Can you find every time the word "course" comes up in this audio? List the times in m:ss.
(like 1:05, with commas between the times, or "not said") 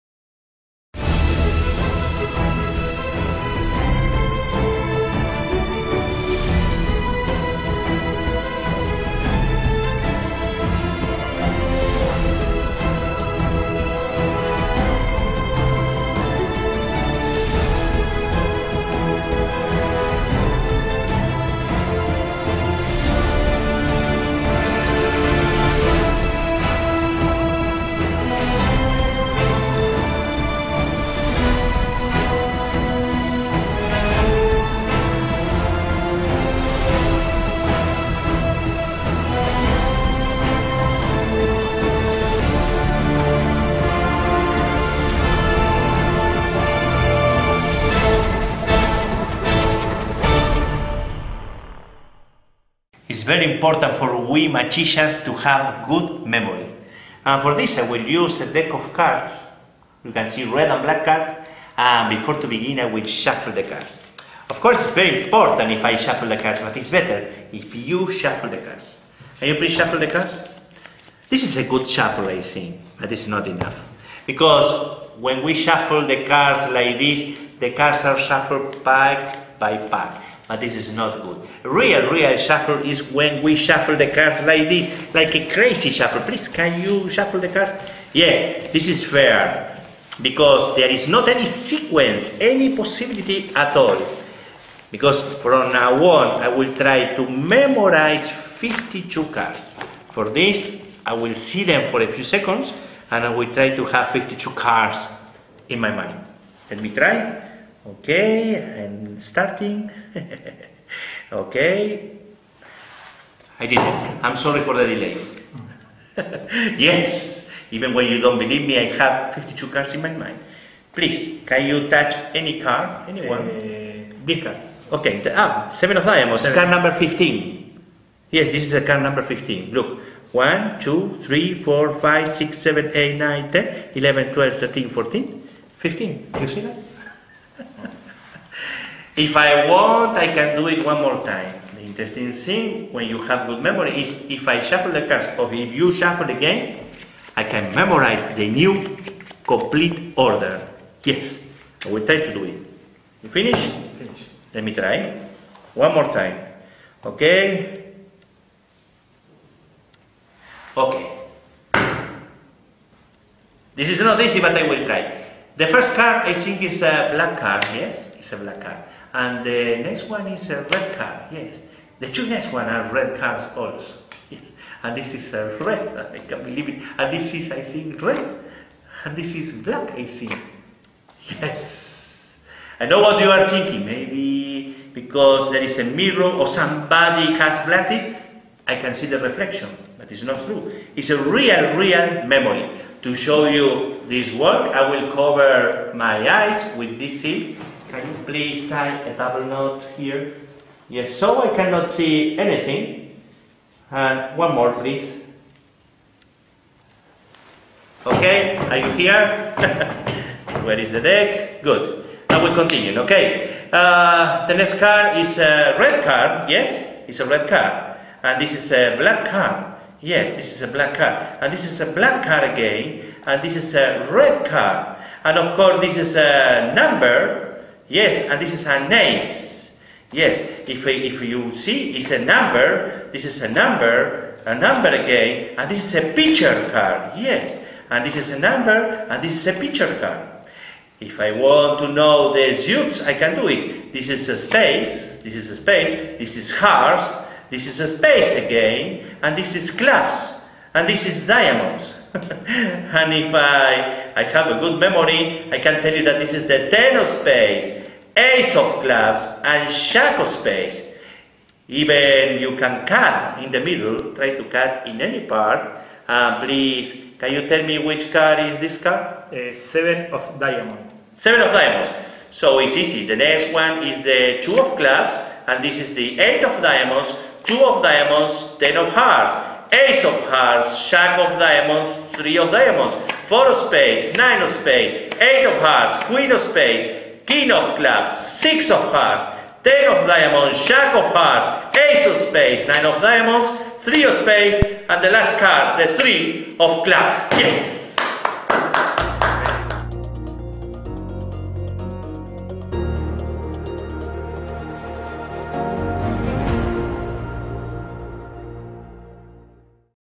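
1:04, 3:45.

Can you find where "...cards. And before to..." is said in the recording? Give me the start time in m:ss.
1:01.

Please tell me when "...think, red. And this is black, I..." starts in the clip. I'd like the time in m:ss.
2:57.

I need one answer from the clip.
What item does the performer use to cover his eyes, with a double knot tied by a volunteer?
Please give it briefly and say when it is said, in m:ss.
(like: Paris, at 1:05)
Silk, at 3:17.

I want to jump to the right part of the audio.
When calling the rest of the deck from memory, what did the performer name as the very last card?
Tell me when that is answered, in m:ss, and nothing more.
4:55.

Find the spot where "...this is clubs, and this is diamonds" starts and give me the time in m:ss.
4:09.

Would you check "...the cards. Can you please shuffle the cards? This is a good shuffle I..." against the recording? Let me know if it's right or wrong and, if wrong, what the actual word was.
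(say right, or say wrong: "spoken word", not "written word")
right.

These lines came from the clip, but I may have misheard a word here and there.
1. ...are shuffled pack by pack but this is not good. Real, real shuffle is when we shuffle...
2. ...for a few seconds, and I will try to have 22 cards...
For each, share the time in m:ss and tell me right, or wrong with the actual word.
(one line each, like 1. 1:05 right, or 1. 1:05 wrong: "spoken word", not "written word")
1. 1:18 right
2. 1:41 wrong: "52", not "22".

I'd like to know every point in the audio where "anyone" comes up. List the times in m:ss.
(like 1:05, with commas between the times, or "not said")
2:03.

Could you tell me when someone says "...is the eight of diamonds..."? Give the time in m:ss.
4:35.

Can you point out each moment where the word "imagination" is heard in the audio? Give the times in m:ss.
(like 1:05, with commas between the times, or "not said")
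not said.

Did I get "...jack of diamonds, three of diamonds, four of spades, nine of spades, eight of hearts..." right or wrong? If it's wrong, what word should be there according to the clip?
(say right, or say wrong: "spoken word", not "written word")
right.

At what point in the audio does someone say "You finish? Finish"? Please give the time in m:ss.
2:33.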